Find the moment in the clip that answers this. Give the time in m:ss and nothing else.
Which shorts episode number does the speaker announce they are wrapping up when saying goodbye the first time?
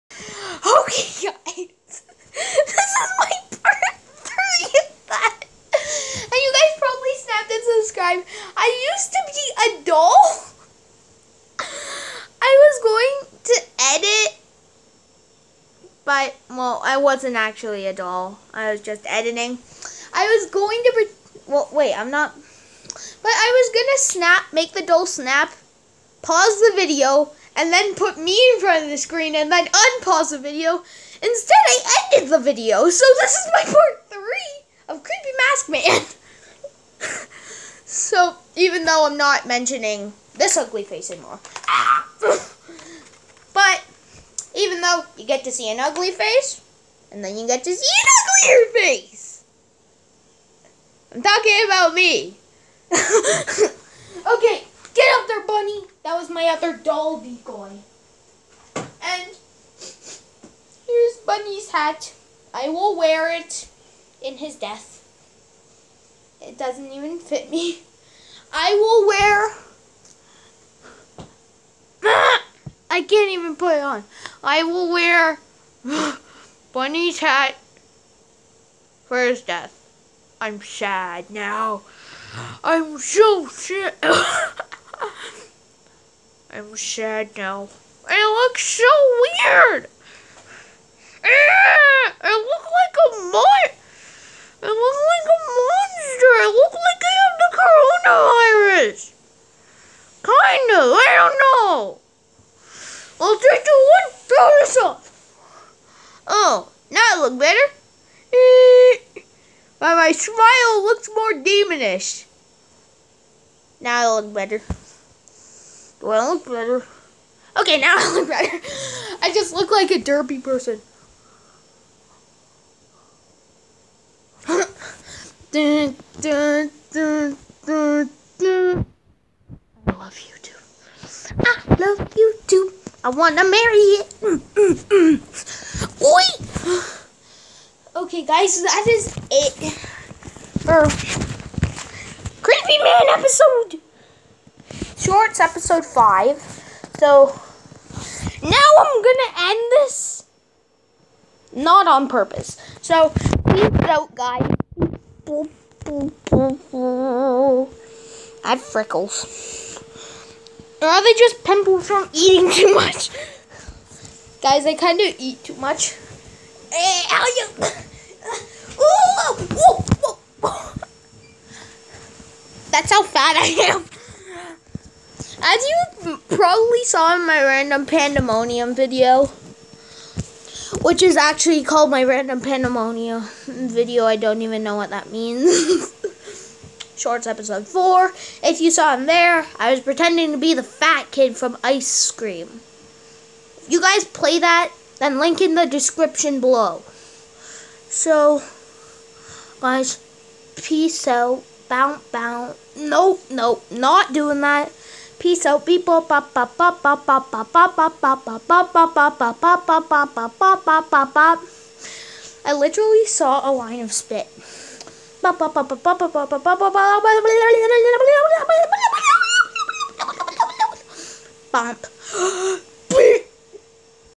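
2:25.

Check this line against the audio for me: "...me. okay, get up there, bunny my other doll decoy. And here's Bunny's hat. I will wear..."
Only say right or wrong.
right.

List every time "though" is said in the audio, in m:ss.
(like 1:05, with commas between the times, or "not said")
0:38, 0:44.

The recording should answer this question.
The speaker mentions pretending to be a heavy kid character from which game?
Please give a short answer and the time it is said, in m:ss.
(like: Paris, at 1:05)
Ice Cream, at 3:11.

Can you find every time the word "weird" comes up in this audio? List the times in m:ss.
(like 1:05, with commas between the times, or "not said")
1:29.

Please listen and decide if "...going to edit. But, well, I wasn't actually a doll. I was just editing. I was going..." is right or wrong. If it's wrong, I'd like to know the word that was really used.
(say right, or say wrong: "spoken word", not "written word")
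right.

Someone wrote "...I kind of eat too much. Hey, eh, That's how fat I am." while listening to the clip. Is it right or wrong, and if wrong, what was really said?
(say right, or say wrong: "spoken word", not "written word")
right.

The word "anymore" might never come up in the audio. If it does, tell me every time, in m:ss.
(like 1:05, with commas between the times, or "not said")
0:41.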